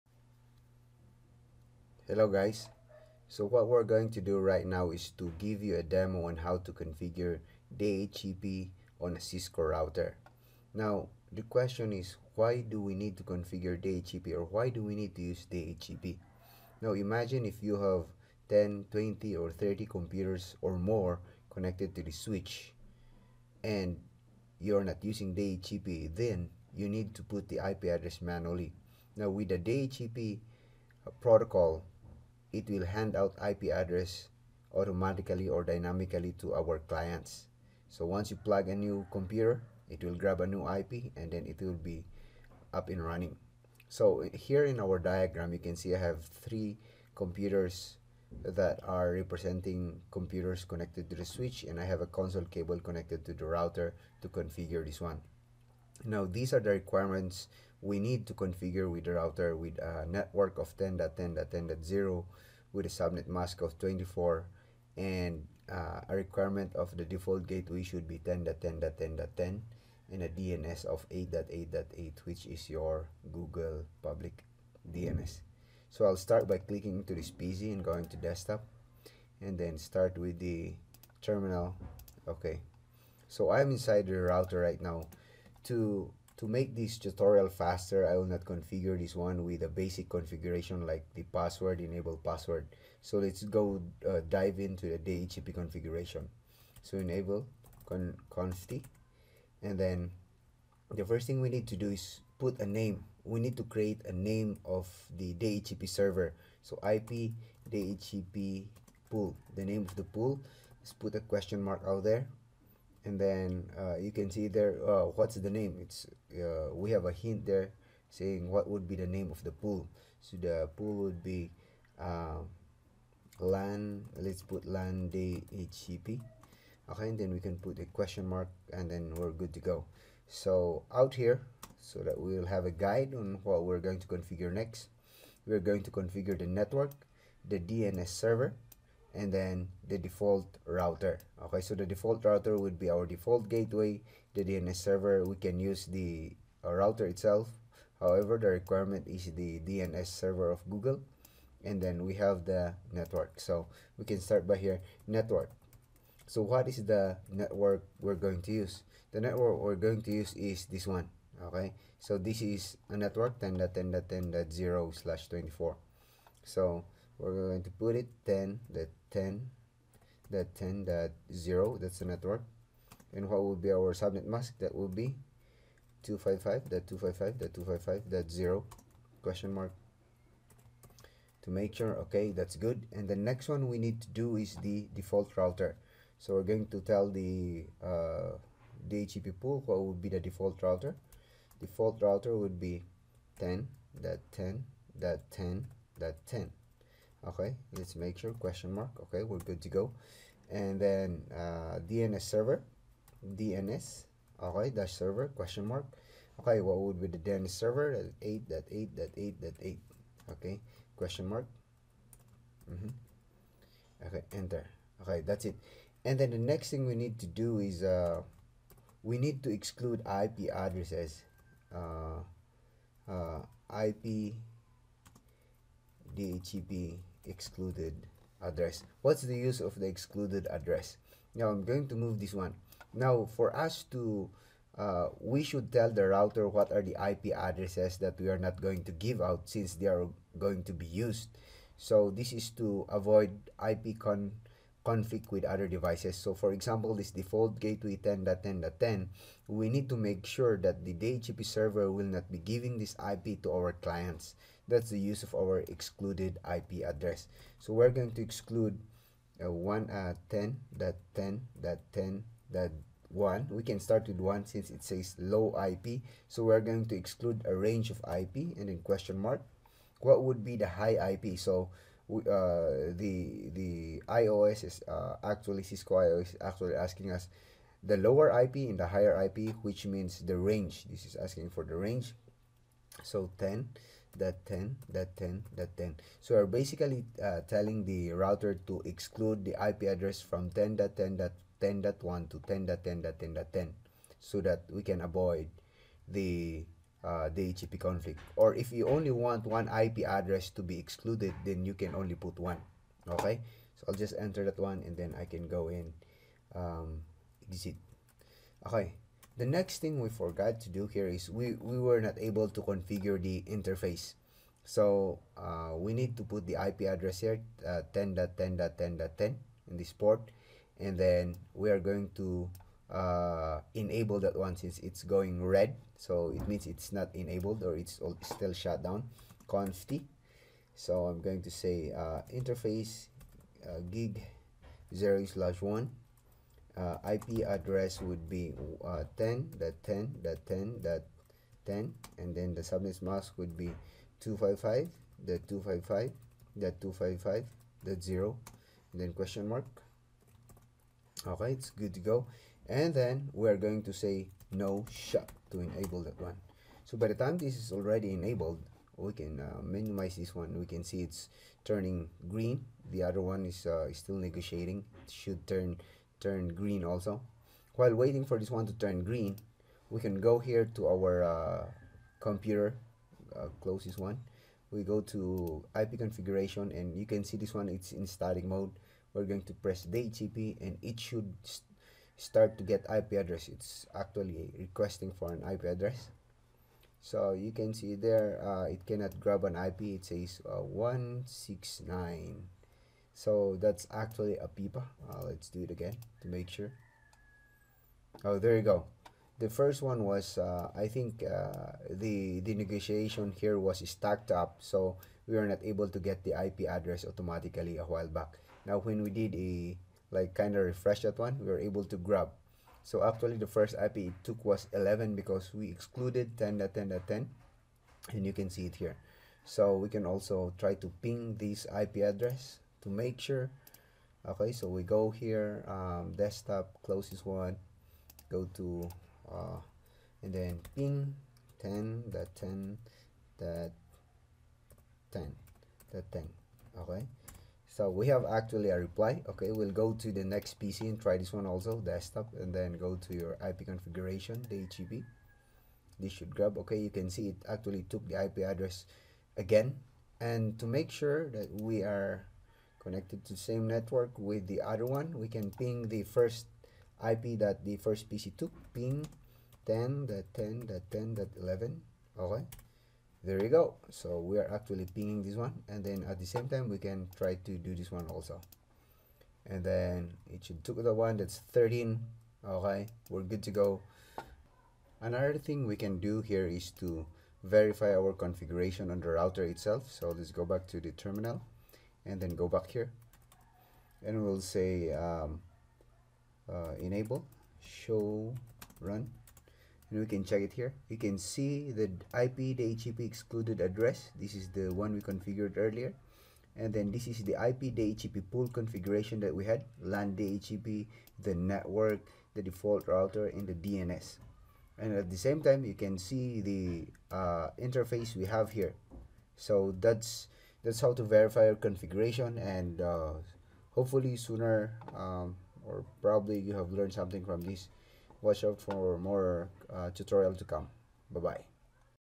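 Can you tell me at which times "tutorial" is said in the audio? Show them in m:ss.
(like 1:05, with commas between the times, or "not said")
1:26, 8:39.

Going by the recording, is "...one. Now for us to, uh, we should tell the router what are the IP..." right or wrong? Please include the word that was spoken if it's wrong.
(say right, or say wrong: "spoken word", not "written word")
right.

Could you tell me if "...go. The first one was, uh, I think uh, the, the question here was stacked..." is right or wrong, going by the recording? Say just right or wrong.
wrong.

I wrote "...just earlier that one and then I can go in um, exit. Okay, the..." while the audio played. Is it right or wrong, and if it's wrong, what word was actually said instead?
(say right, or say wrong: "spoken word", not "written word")
wrong: "enter", not "earlier".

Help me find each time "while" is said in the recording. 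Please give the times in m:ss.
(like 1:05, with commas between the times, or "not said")
6:07, 6:47.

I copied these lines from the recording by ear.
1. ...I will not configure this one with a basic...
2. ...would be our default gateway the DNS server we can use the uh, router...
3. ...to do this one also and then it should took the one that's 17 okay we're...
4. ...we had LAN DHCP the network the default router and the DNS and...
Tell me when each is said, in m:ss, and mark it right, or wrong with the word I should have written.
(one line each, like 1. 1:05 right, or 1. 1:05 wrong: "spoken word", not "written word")
1. 1:28 right
2. 2:22 right
3. 7:47 wrong: "13", not "17"
4. 8:19 right.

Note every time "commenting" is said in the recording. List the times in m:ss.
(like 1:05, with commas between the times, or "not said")
not said.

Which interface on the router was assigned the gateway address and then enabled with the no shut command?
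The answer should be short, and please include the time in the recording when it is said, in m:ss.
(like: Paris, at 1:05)
gig 0/1, at 5:33.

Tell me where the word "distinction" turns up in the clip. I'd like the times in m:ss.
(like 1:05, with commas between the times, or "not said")
not said.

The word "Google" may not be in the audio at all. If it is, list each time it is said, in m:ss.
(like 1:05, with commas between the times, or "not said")
1:13, 2:30.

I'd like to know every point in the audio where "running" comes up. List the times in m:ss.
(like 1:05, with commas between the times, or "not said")
0:43.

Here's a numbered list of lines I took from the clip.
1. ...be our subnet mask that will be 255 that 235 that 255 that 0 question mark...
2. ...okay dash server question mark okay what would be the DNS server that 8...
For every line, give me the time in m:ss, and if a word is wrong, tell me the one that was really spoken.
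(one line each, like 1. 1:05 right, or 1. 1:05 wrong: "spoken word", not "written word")
1. 2:53 wrong: "255", not "235"
2. 3:24 right.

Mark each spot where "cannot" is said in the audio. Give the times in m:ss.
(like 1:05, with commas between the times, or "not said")
6:28.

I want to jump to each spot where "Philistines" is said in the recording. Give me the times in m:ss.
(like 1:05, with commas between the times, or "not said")
not said.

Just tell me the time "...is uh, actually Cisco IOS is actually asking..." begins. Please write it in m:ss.
4:34.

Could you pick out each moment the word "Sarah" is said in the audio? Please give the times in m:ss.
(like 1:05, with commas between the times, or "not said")
not said.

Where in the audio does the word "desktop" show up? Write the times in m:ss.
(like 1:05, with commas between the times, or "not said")
1:18, 7:06, 7:21.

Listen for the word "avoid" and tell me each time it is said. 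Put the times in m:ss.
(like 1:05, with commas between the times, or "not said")
4:02, 4:55.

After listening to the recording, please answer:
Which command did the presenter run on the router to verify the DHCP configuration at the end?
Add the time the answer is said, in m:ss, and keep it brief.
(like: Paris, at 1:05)
show run, at 8:07.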